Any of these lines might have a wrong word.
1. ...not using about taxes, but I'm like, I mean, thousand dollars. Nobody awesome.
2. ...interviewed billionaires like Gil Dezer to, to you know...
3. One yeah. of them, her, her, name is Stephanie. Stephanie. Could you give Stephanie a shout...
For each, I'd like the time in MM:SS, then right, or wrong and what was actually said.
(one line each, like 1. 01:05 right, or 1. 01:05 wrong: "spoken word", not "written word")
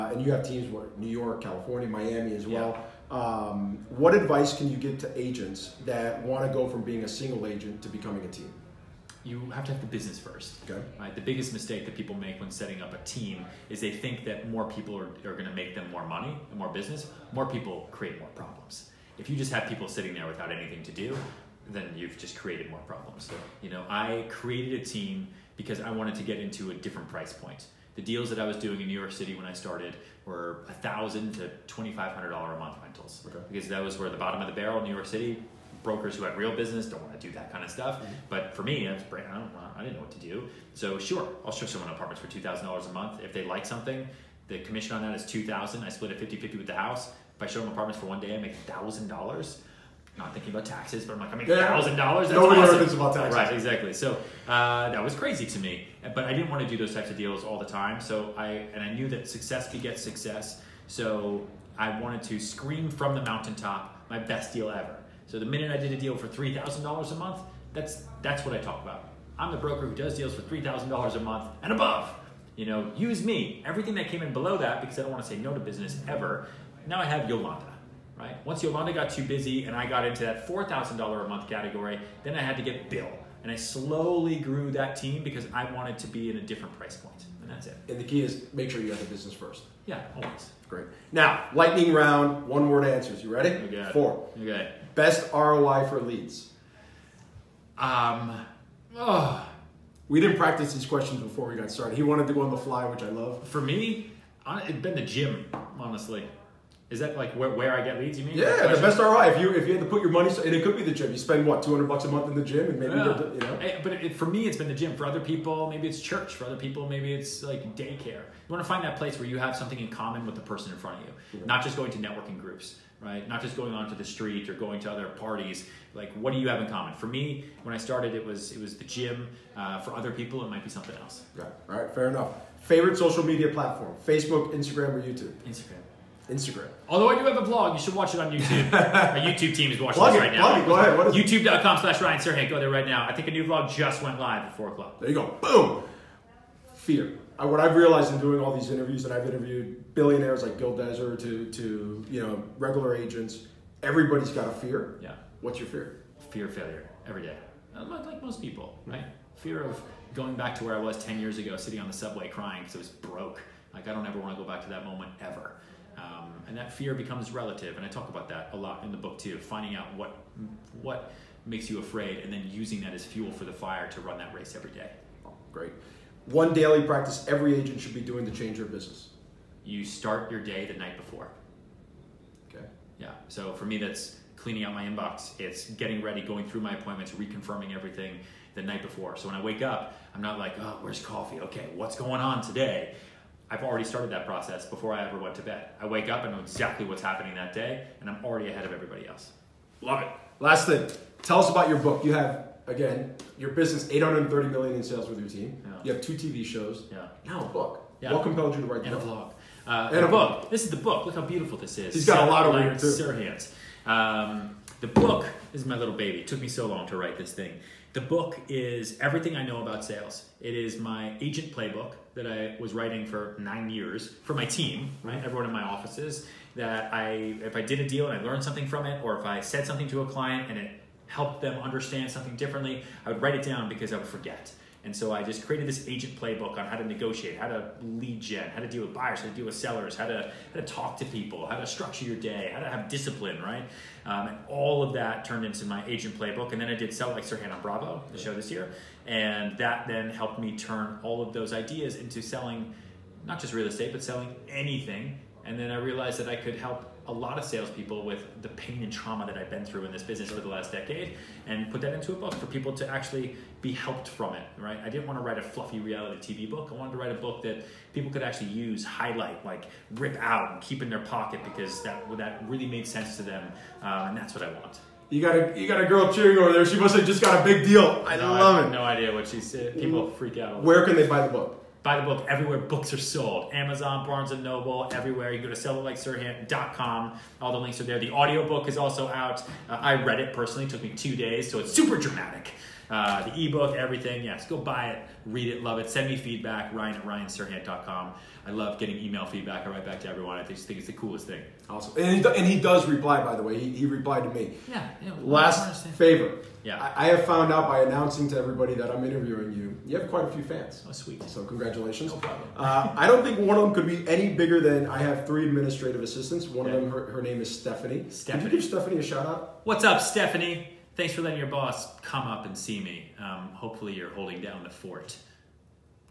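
1. 00:50 wrong: "thinking", not "using"
2. 02:29 right
3. 05:16 right.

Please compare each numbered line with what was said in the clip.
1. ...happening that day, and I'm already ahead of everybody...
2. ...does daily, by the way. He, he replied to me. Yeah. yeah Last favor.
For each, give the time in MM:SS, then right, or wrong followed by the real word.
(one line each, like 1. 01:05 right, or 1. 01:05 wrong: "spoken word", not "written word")
1. 03:17 right
2. 05:02 wrong: "reply", not "daily".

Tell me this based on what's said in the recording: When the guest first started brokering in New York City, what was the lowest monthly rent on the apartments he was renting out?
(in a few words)
$1,000.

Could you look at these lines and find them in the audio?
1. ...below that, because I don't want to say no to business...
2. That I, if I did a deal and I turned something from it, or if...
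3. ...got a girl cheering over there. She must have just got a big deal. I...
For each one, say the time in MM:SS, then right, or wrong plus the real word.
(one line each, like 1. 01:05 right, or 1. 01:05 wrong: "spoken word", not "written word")
1. 01:14 right
2. 03:46 wrong: "learned", not "turned"
3. 04:35 right.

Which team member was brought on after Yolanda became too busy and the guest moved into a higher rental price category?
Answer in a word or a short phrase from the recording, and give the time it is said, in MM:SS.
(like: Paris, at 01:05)
Bill, at 01:22.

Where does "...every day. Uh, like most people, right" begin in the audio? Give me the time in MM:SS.
02:37.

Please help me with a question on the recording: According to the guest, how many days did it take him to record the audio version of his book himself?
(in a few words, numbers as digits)
2.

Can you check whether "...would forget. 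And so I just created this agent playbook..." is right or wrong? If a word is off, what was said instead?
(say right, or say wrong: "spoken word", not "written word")
right.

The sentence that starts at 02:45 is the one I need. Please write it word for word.
Um, and that fear becomes relative, and I talk about that a lot in the book too.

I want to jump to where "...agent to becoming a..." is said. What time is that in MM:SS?
00:07.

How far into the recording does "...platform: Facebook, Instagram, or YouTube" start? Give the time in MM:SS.
02:13.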